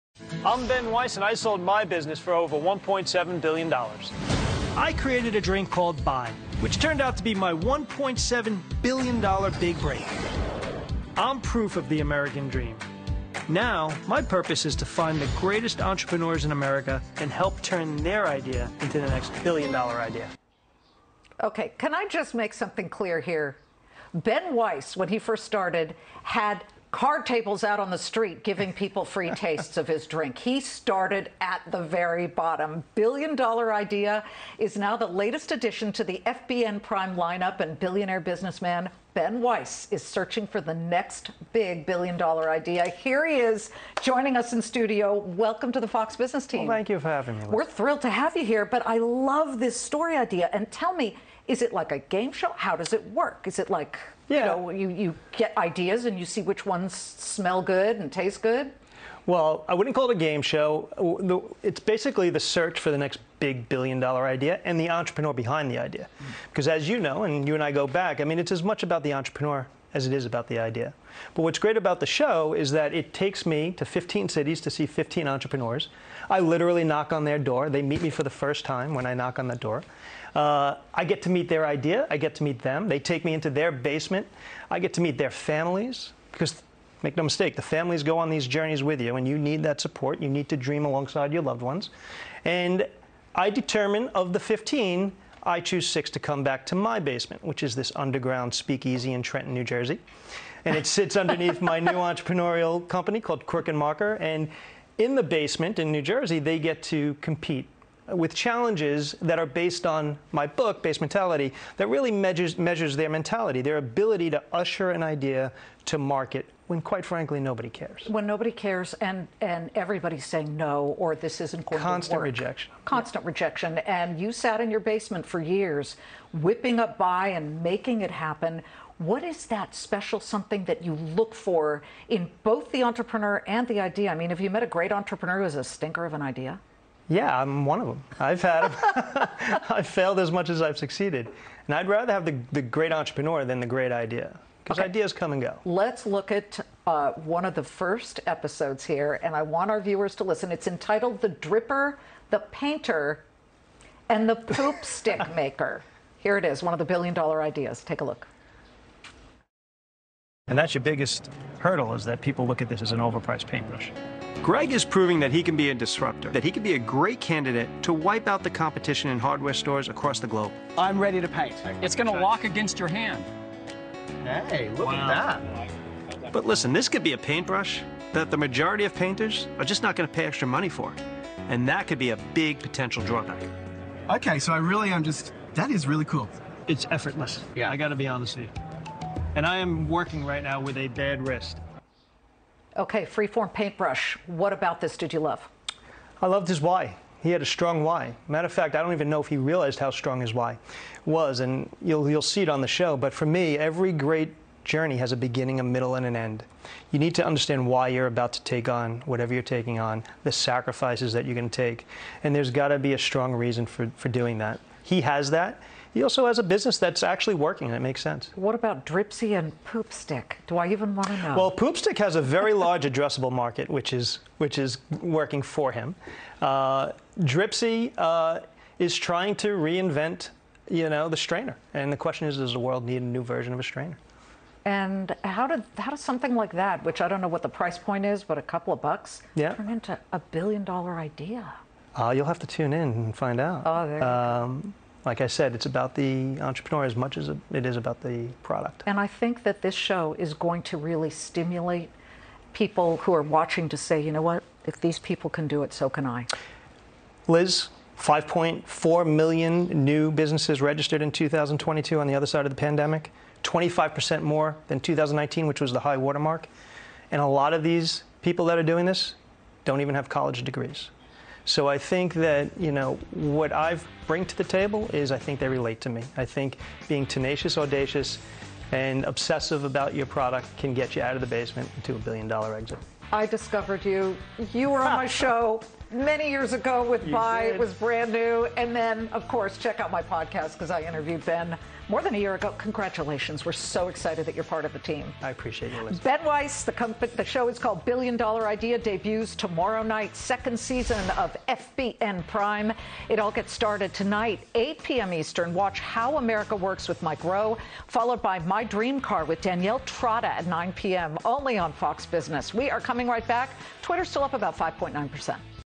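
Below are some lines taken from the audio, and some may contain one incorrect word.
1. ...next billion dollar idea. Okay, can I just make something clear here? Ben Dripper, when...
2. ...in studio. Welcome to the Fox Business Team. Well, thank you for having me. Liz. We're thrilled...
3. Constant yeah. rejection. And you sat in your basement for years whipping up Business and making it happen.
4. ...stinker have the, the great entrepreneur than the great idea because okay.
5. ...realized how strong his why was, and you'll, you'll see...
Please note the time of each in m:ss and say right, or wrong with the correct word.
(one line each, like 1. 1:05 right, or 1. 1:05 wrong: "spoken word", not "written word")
1. 0:19 wrong: "Weiss", not "Dripper"
2. 0:44 right
3. 2:02 wrong: "Bai", not "Business"
4. 2:21 wrong: "rather", not "stinker"
5. 3:19 right.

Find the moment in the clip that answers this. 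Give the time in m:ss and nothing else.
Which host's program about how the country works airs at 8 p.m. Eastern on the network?
5:07.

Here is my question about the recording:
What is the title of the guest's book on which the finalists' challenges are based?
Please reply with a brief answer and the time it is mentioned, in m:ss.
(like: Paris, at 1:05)
Basementality, at 1:50.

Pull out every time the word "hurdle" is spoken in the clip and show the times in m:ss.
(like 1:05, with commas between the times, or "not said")
2:41.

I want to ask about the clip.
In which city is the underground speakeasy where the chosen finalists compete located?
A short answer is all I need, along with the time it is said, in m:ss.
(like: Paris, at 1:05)
Trenton, New Jersey, at 1:39.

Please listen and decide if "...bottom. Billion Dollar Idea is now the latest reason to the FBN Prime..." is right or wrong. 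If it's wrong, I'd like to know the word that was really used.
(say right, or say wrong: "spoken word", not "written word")
wrong: "addition", not "reason".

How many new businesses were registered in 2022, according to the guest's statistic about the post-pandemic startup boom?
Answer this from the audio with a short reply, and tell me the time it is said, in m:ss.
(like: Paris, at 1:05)
5.4 million, at 4:17.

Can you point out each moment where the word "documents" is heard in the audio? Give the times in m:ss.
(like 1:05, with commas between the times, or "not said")
not said.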